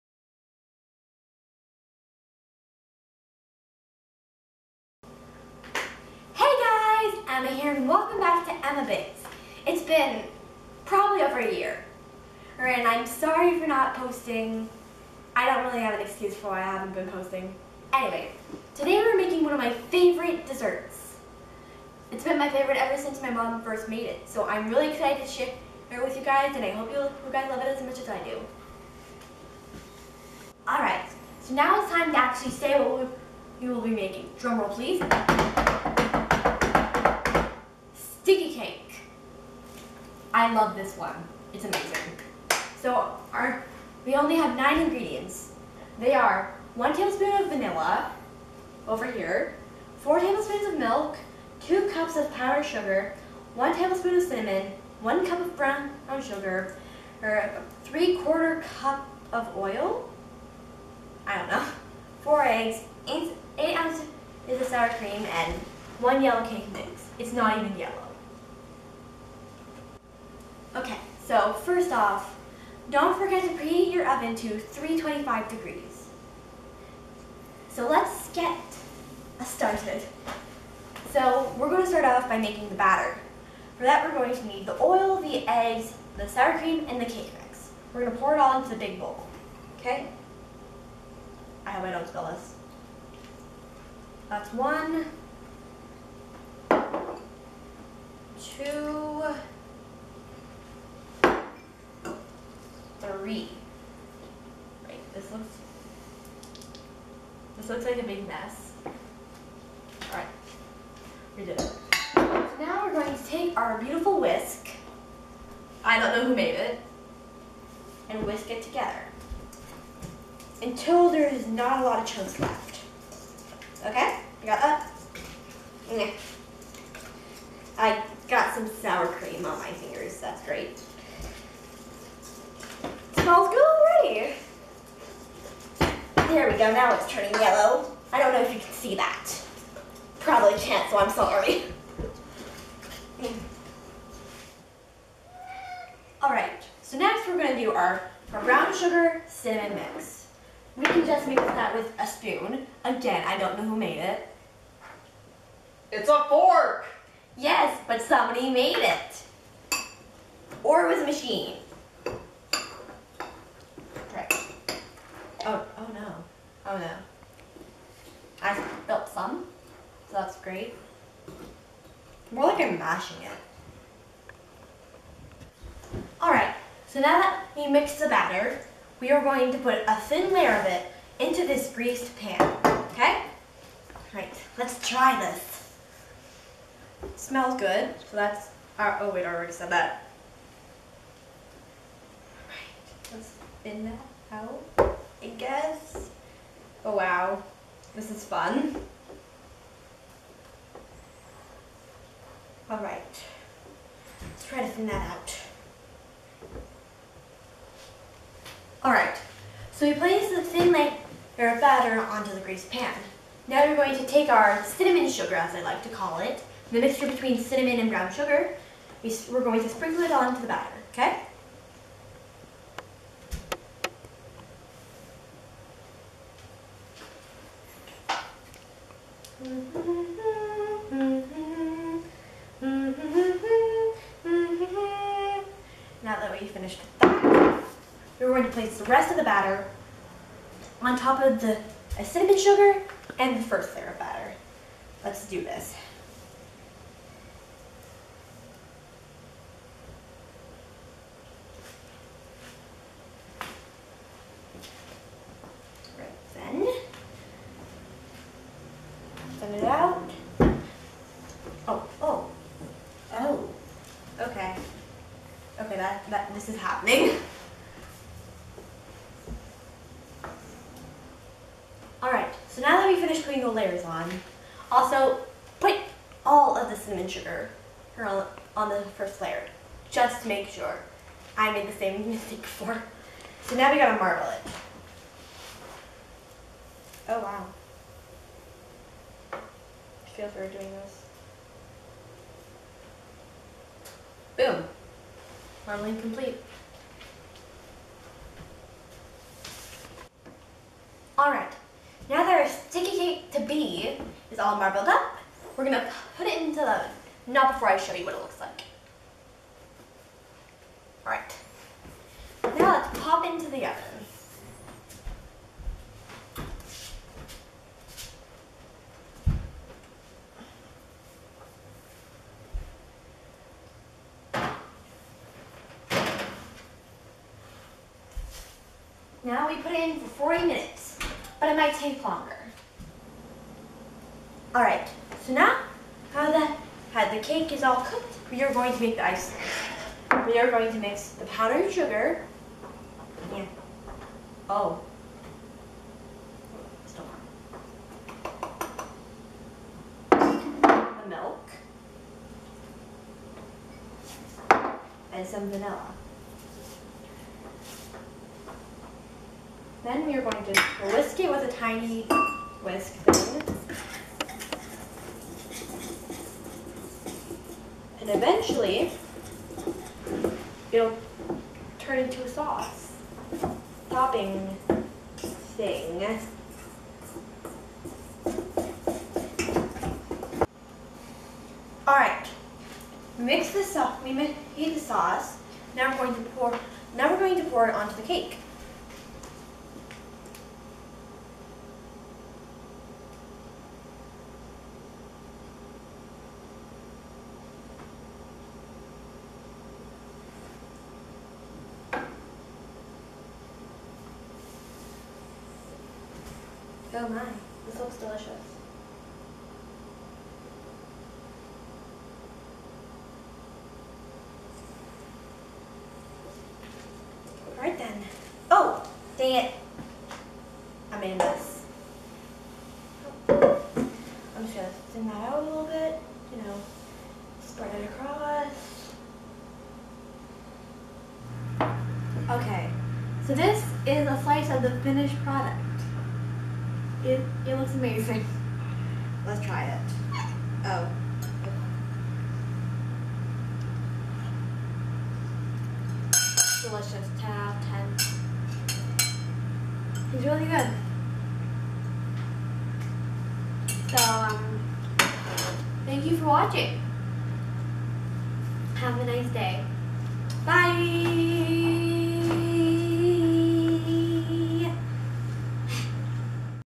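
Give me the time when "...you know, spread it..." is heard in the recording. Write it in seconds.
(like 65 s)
426 s.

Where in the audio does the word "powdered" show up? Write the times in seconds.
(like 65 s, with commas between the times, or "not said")
52 s, 341 s.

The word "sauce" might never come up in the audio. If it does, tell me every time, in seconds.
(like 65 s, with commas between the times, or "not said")
372 s, 384 s.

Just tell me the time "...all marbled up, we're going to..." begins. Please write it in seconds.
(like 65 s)
304 s.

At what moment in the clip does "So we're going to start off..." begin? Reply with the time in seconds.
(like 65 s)
81 s.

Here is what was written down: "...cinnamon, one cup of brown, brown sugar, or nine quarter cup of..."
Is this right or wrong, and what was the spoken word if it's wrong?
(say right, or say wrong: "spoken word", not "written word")
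wrong: "three", not "nine".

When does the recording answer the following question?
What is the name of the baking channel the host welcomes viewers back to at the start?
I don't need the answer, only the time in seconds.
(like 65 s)
8 s.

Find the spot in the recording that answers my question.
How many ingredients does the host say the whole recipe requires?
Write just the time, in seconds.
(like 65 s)
44 s.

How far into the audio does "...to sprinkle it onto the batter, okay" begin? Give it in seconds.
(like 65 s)
219 s.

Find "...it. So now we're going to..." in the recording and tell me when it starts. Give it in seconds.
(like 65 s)
111 s.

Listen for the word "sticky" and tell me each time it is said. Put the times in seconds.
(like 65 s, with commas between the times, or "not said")
302 s.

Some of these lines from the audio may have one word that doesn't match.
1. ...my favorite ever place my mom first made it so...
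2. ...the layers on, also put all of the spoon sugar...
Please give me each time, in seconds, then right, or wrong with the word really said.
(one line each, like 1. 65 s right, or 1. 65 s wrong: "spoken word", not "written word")
1. 22 s wrong: "since", not "place"
2. 273 s wrong: "cinnamon", not "spoon".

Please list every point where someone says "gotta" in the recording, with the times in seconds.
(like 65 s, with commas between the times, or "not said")
283 s.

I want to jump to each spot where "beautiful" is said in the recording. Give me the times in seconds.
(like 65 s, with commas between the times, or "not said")
113 s.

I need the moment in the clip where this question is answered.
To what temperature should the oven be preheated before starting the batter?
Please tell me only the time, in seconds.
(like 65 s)
74 s.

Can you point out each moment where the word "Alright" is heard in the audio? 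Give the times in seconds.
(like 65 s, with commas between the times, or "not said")
30 s, 146 s, 176 s, 272 s, 301 s, 311 s, 381 s, 417 s.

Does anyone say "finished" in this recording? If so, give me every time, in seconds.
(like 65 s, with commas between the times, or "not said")
236 s, 273 s, 434 s.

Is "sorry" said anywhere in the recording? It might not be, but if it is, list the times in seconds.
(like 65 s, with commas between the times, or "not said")
13 s, 141 s.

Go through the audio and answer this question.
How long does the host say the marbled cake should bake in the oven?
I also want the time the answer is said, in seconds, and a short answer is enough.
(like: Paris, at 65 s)
40 minutes, at 330 s.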